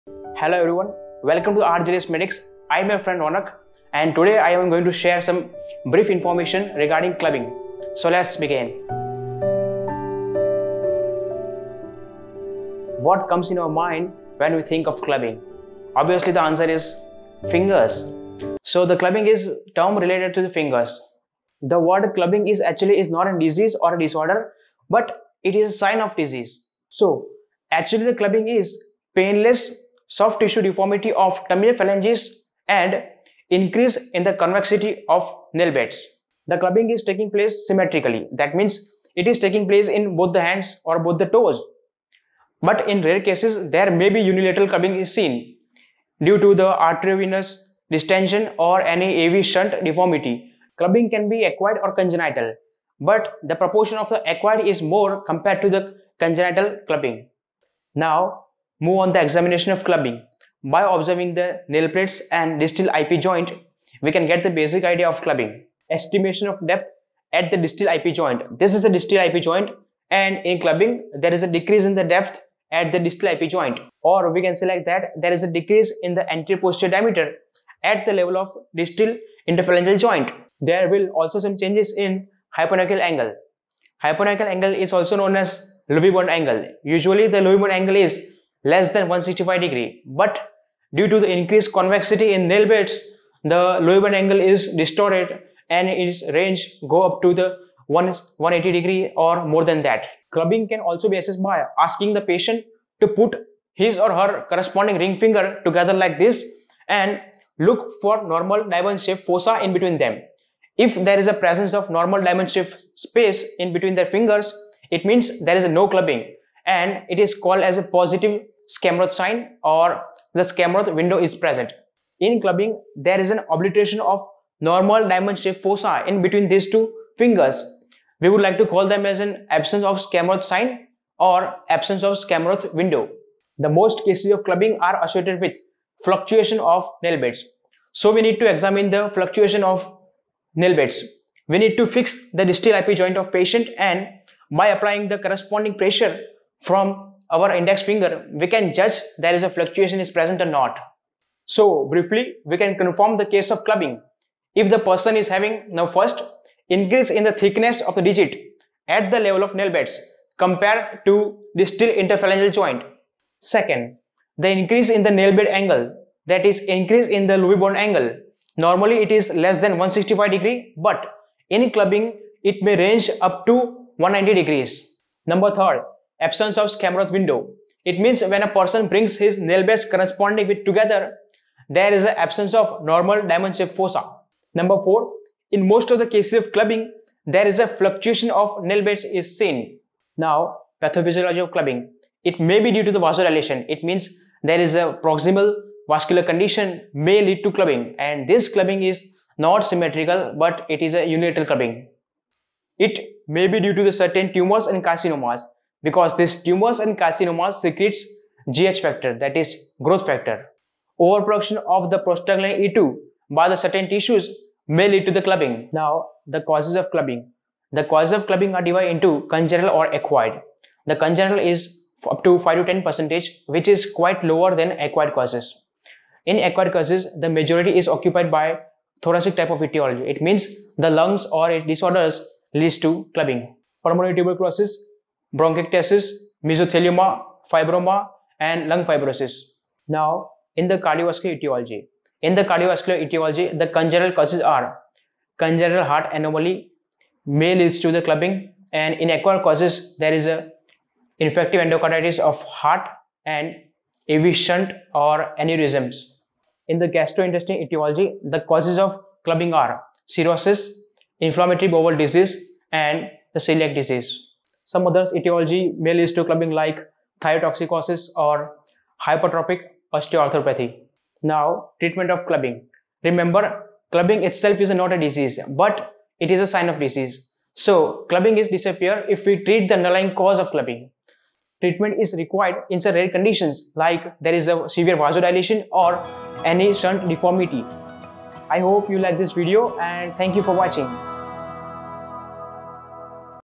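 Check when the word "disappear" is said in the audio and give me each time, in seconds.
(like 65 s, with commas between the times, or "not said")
278 s.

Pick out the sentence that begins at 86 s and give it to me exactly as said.
Usually the Lovibond angle is less than 165 degree.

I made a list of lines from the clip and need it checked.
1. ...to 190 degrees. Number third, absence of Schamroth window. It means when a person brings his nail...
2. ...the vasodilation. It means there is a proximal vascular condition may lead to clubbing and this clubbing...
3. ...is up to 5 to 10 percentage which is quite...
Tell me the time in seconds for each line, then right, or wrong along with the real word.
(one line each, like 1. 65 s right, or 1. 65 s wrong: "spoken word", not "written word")
1. 173 s right
2. 192 s right
3. 221 s right.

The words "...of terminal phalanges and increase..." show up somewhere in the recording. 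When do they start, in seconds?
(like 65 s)
31 s.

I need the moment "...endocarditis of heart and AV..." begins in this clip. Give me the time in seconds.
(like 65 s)
251 s.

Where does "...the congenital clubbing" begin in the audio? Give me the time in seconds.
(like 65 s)
55 s.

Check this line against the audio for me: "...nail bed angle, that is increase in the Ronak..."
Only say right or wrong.
wrong.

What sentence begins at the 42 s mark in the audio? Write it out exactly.
But in rare cases, there may be unilateral clubbing is seen due to the arteriovenous distension or any AV shunt deformity.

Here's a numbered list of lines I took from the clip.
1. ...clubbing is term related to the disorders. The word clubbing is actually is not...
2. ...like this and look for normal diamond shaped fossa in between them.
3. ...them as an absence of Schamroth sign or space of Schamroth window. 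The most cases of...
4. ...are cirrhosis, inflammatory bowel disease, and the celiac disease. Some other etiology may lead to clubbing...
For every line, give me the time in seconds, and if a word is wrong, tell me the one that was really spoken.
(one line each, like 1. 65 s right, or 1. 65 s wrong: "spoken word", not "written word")
1. 18 s wrong: "fingers", not "disorders"
2. 105 s right
3. 128 s wrong: "absence", not "space"
4. 259 s right.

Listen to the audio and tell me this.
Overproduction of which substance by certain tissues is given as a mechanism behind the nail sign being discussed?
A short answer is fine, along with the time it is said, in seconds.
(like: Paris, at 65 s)
prostaglandin E2, at 211 s.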